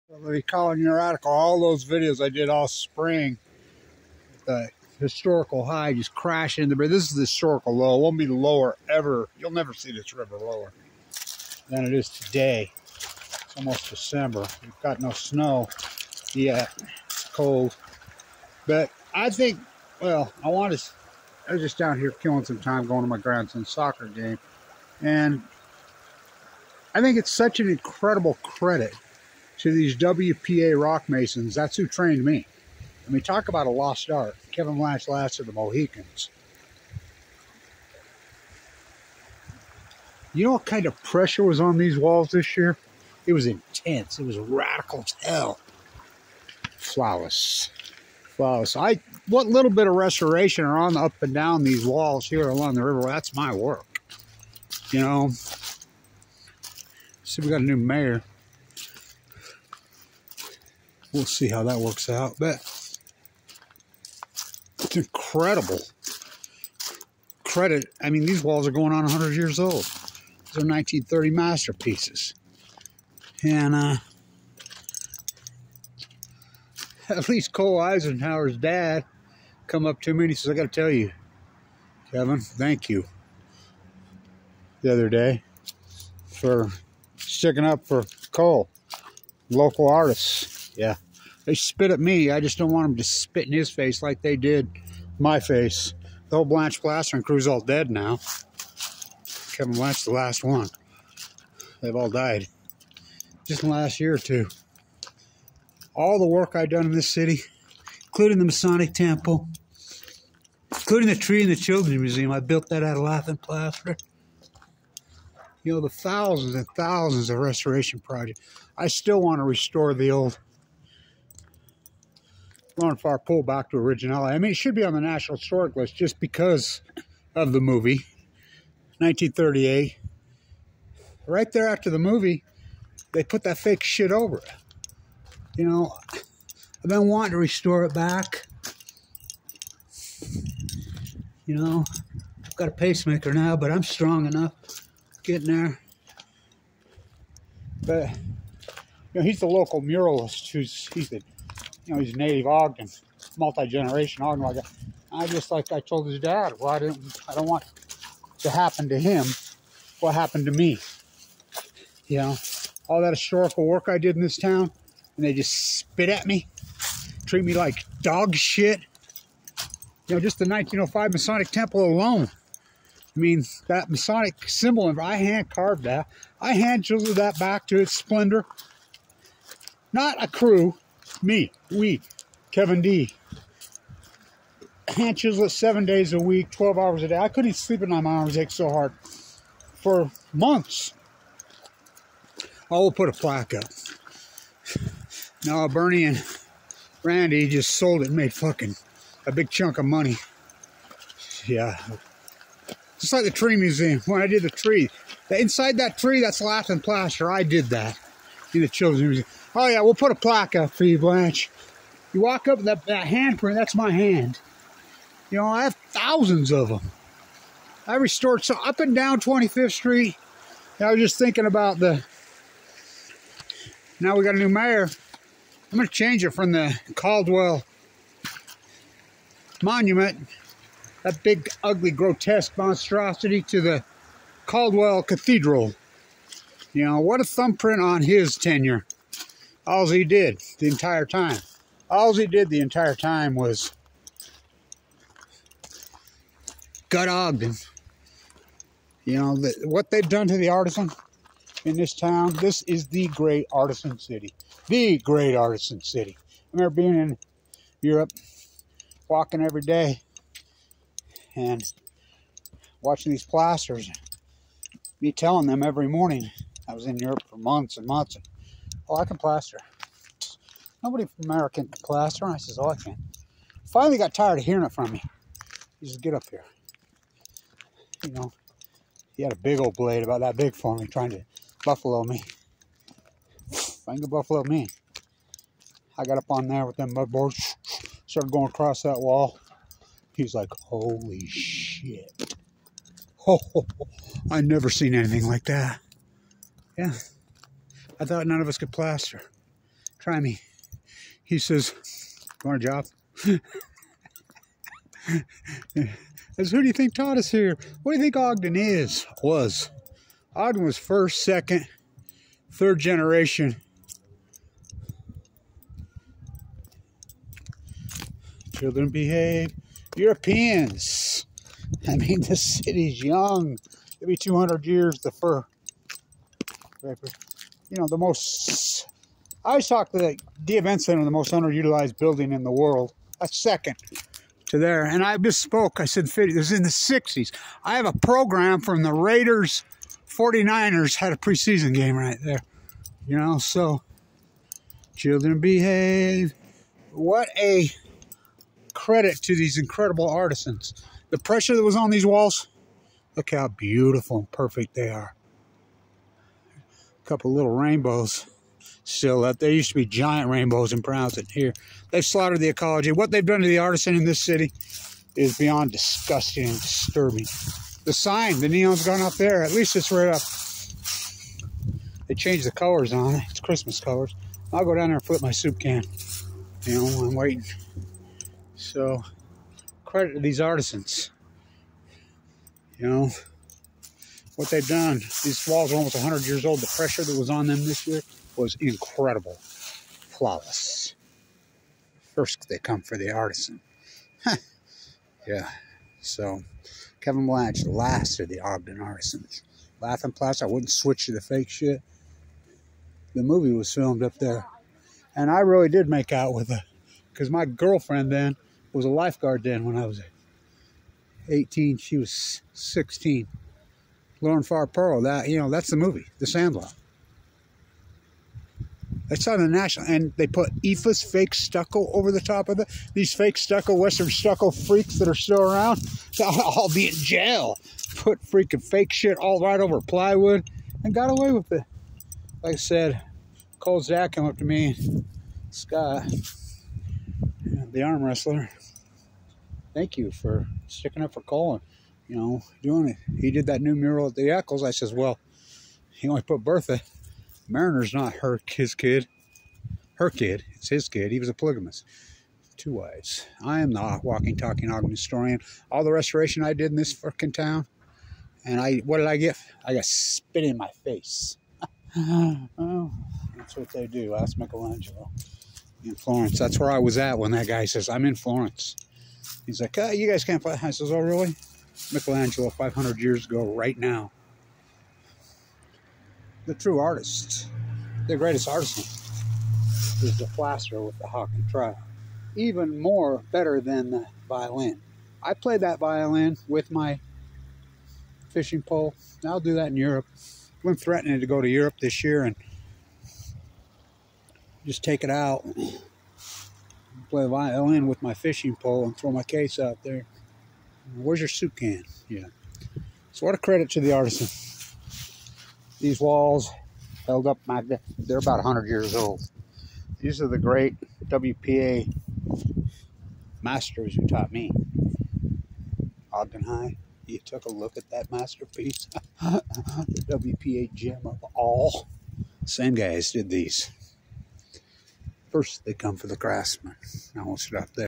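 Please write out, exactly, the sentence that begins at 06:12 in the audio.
They changed the colors on it.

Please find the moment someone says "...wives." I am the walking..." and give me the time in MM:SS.
07:32.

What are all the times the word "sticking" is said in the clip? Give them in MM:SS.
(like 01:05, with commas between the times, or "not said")
01:27, 07:20.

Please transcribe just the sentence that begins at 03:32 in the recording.
You walk up that, that handprint, that's my hand.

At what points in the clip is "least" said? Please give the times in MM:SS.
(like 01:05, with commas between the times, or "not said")
01:17, 06:09.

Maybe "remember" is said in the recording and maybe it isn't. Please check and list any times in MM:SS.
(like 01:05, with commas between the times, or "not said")
04:16.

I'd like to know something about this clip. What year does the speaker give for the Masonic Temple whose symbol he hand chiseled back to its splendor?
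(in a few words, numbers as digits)
1905.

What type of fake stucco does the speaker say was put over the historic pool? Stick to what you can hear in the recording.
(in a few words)
EIFS.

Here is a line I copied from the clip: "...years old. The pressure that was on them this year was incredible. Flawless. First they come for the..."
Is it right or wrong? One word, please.
right.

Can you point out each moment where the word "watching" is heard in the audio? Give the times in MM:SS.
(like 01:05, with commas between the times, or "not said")
04:22.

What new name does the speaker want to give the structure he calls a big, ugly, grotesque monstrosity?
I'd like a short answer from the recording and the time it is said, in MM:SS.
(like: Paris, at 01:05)
Caldwell Cathedral, at 03:54.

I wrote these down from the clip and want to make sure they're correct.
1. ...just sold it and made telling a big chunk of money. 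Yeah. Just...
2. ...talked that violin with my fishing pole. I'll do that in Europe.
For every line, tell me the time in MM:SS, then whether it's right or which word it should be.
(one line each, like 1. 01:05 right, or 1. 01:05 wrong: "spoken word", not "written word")
1. 03:17 wrong: "fucking", not "telling"
2. 08:05 wrong: "played", not "talked".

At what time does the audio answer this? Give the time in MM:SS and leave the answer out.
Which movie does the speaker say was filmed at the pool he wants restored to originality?
06:56.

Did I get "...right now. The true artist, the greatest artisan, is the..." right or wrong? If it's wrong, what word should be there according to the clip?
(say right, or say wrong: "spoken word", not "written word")
right.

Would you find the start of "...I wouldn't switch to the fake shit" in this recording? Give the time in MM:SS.
06:40.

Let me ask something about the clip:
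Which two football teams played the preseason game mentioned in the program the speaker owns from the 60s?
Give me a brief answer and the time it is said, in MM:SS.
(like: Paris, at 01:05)
Raiders and 49ers, at 05:38.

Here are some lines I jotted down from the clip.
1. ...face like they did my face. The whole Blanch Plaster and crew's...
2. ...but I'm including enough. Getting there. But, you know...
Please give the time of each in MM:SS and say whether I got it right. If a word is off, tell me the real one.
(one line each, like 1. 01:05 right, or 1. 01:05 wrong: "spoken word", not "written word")
1. 01:33 right
2. 02:23 wrong: "strong", not "including".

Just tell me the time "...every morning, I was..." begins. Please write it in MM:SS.
04:25.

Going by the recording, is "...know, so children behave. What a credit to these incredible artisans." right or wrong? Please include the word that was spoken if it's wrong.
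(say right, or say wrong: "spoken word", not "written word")
right.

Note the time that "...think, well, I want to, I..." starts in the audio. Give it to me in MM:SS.
00:19.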